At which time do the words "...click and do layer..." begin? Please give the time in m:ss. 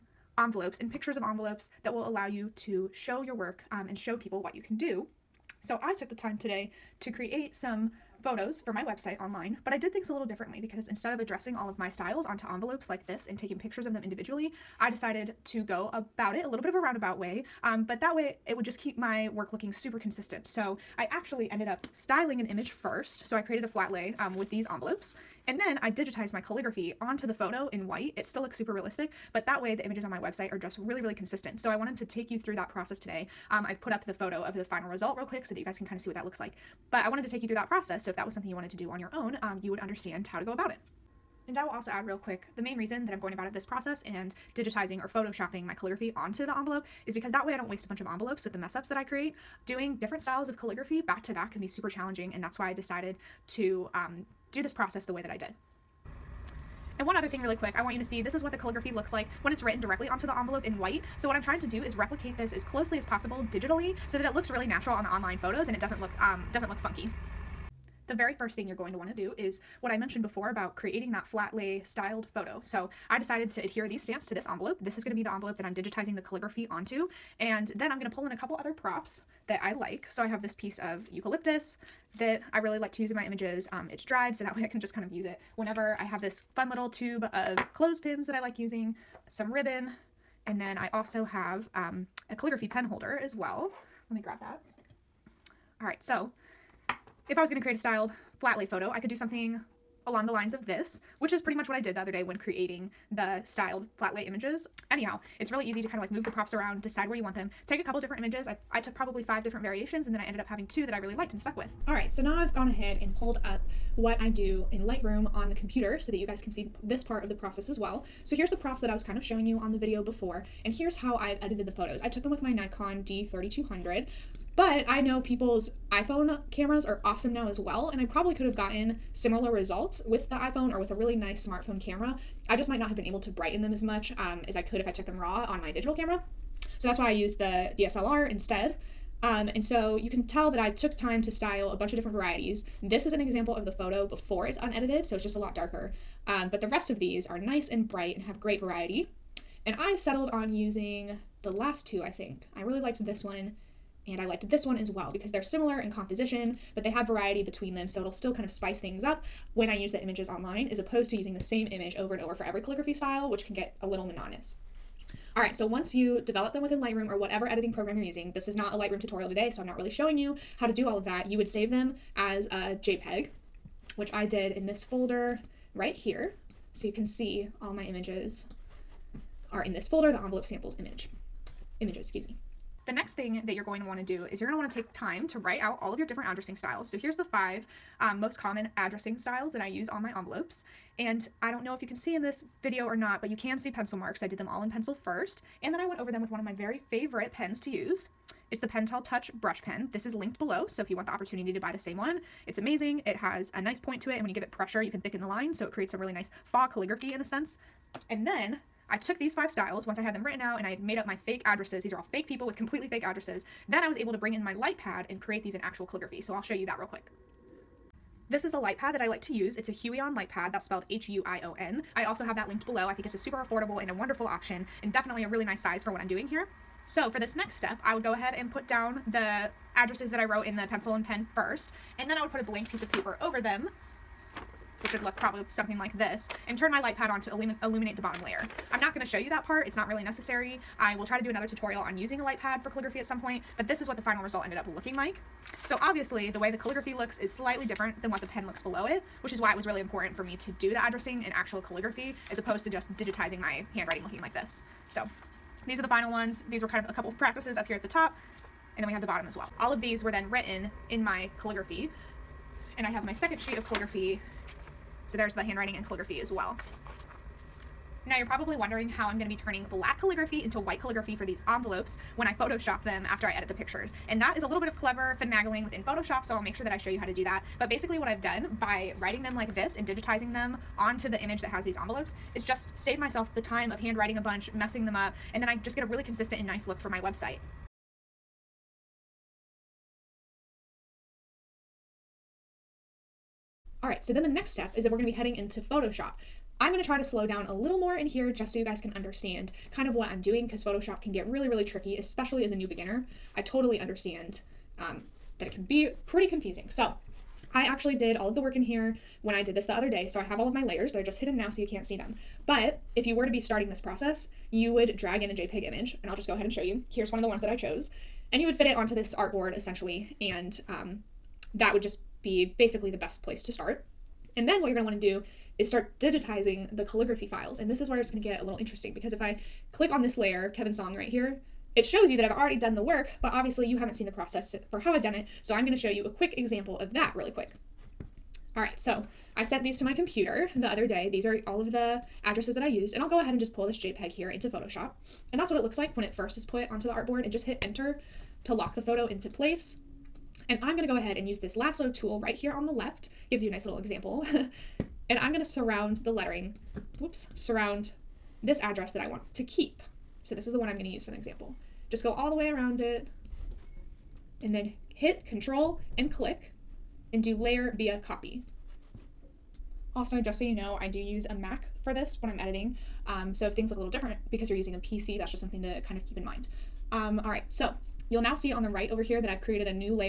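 6:06.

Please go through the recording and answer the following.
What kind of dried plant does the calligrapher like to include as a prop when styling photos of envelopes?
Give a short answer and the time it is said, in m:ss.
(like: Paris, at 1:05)
Eucalyptus, at 1:21.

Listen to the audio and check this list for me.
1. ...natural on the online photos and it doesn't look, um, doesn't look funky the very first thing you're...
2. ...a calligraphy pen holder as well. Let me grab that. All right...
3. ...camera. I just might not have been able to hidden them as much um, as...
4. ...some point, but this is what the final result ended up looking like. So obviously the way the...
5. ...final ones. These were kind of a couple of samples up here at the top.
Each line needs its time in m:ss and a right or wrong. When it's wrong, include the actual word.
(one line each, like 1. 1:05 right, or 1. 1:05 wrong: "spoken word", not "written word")
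1. 1:04 right
2. 1:32 right
3. 2:11 wrong: "brighten", not "hidden"
4. 4:03 right
5. 4:15 wrong: "practices", not "samples".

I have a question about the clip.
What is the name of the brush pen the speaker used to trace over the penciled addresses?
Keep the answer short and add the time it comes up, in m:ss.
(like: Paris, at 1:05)
Pentel Touch Brush Pen, at 3:18.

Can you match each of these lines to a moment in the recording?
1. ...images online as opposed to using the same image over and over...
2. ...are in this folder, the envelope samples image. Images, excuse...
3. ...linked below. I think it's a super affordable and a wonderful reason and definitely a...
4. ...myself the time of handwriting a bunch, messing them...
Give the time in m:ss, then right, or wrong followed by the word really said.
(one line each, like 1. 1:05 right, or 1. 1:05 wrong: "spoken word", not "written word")
1. 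2:40 right
2. 2:59 right
3. 3:42 wrong: "option", not "reason"
4. 4:42 right.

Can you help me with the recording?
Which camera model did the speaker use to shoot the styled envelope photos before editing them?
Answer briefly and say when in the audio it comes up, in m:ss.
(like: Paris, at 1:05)
Nikon D3200, at 2:02.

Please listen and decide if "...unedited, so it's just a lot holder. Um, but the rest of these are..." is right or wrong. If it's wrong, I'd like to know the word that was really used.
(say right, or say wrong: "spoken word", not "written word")
wrong: "darker", not "holder".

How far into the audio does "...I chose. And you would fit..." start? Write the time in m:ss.
5:17.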